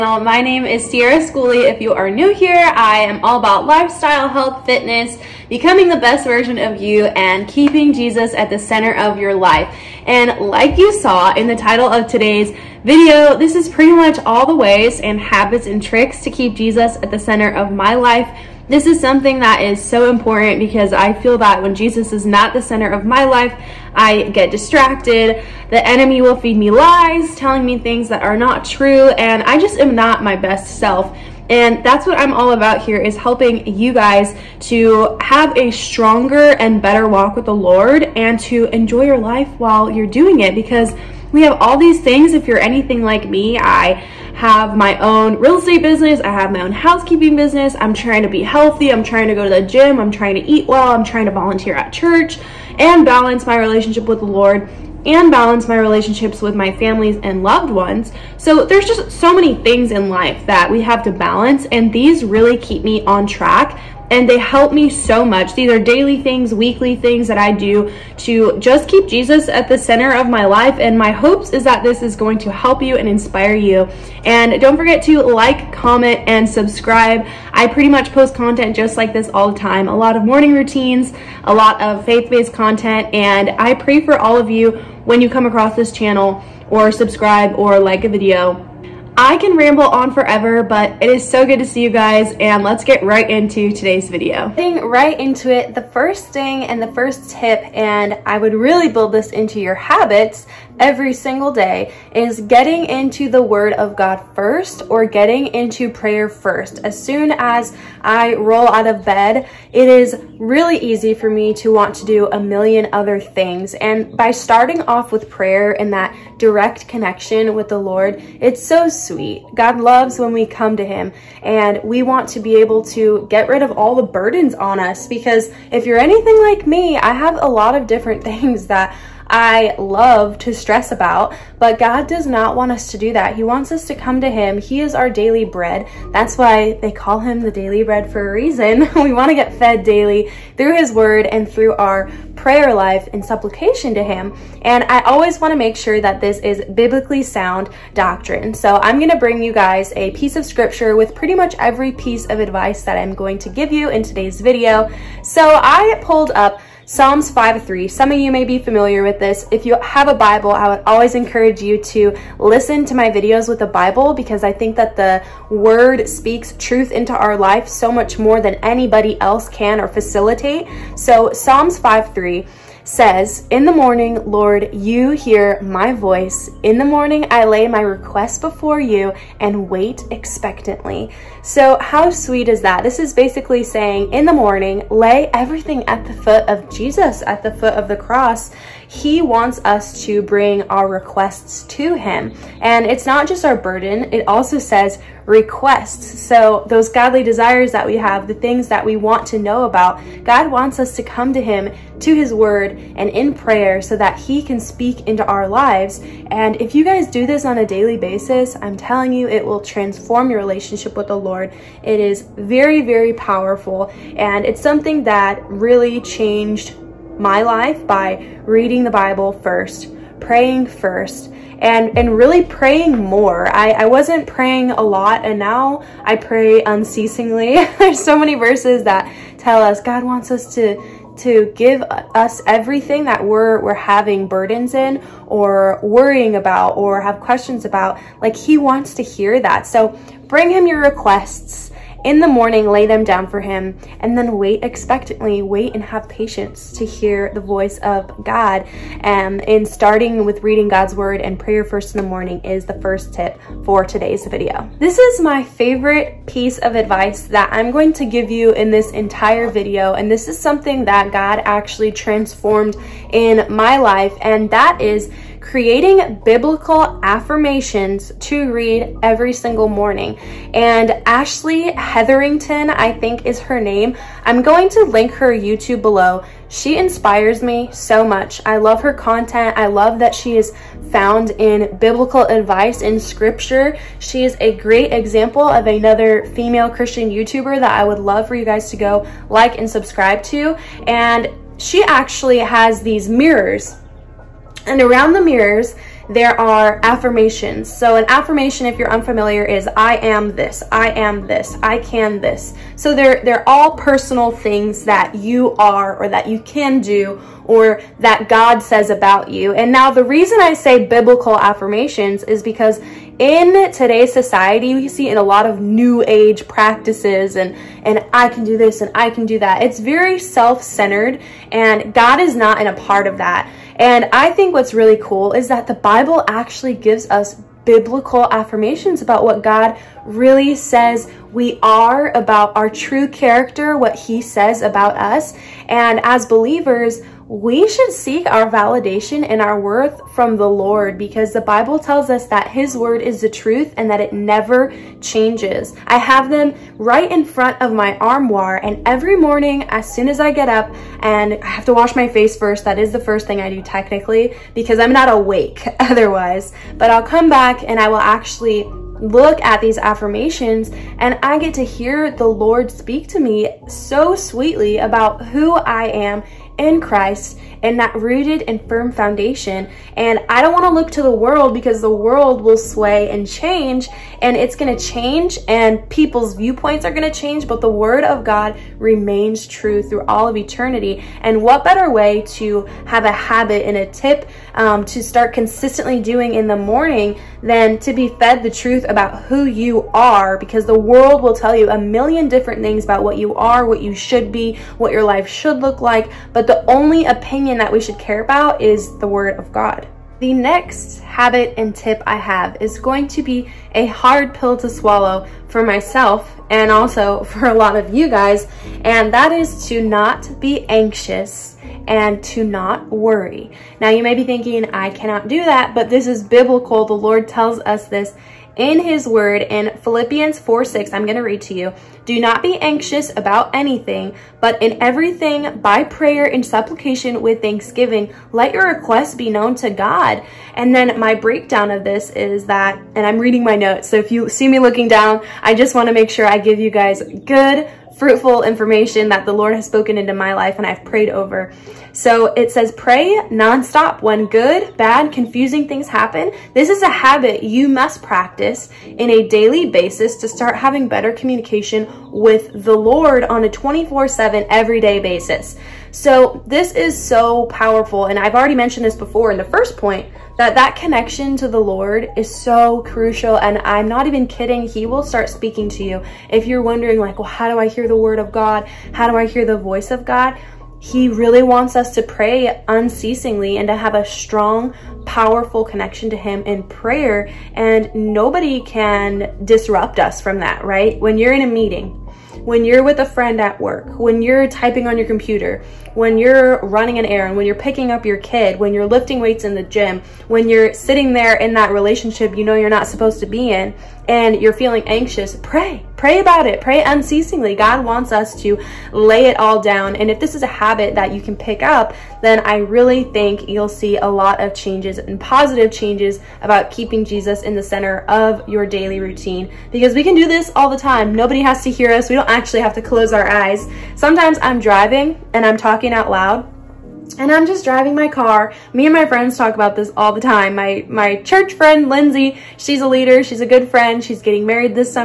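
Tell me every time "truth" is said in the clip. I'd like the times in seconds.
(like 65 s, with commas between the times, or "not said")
166 s, 343 s, 388 s.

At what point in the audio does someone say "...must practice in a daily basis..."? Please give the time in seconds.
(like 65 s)
447 s.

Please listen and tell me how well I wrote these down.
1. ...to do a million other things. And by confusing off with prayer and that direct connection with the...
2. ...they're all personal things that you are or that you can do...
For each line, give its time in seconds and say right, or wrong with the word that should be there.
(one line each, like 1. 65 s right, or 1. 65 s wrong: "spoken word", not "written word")
1. 111 s wrong: "starting", not "confusing"
2. 303 s right.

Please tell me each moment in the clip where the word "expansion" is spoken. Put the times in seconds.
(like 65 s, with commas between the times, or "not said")
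not said.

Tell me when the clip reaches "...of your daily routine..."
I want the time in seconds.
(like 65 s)
508 s.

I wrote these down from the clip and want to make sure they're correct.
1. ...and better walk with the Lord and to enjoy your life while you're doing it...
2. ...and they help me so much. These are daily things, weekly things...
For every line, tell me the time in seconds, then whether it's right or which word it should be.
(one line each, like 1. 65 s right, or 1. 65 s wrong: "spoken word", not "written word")
1. 36 s right
2. 64 s right.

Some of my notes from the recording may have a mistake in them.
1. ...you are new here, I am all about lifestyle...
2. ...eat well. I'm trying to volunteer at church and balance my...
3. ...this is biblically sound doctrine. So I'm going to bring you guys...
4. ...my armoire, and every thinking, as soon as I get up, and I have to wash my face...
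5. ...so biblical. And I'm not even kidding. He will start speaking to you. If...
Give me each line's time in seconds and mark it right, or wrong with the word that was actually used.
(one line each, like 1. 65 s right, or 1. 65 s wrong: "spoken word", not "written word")
1. 1 s right
2. 50 s right
3. 146 s right
4. 347 s wrong: "morning", not "thinking"
5. 462 s wrong: "crucial", not "biblical".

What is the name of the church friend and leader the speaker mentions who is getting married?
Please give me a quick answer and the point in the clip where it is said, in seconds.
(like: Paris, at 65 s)
Lindsay, at 521 s.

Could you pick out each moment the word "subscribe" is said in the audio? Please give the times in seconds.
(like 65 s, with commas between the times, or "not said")
76 s, 86 s, 289 s.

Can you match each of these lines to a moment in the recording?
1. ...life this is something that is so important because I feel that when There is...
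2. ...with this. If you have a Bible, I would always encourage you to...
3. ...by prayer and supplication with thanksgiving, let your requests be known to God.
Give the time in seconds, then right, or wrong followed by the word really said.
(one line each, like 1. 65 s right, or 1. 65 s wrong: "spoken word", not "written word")
1. 17 s wrong: "Jesus", not "There"
2. 159 s right
3. 425 s right.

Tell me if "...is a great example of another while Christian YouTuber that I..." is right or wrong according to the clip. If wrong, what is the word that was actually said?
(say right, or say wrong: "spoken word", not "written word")
wrong: "female", not "while".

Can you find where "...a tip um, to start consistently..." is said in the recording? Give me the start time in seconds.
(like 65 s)
383 s.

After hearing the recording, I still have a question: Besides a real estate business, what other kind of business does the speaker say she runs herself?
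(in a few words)
Housekeeping business.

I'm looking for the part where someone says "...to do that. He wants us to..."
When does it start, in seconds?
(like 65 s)
132 s.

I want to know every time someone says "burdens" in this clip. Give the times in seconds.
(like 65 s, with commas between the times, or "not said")
124 s, 193 s, 234 s.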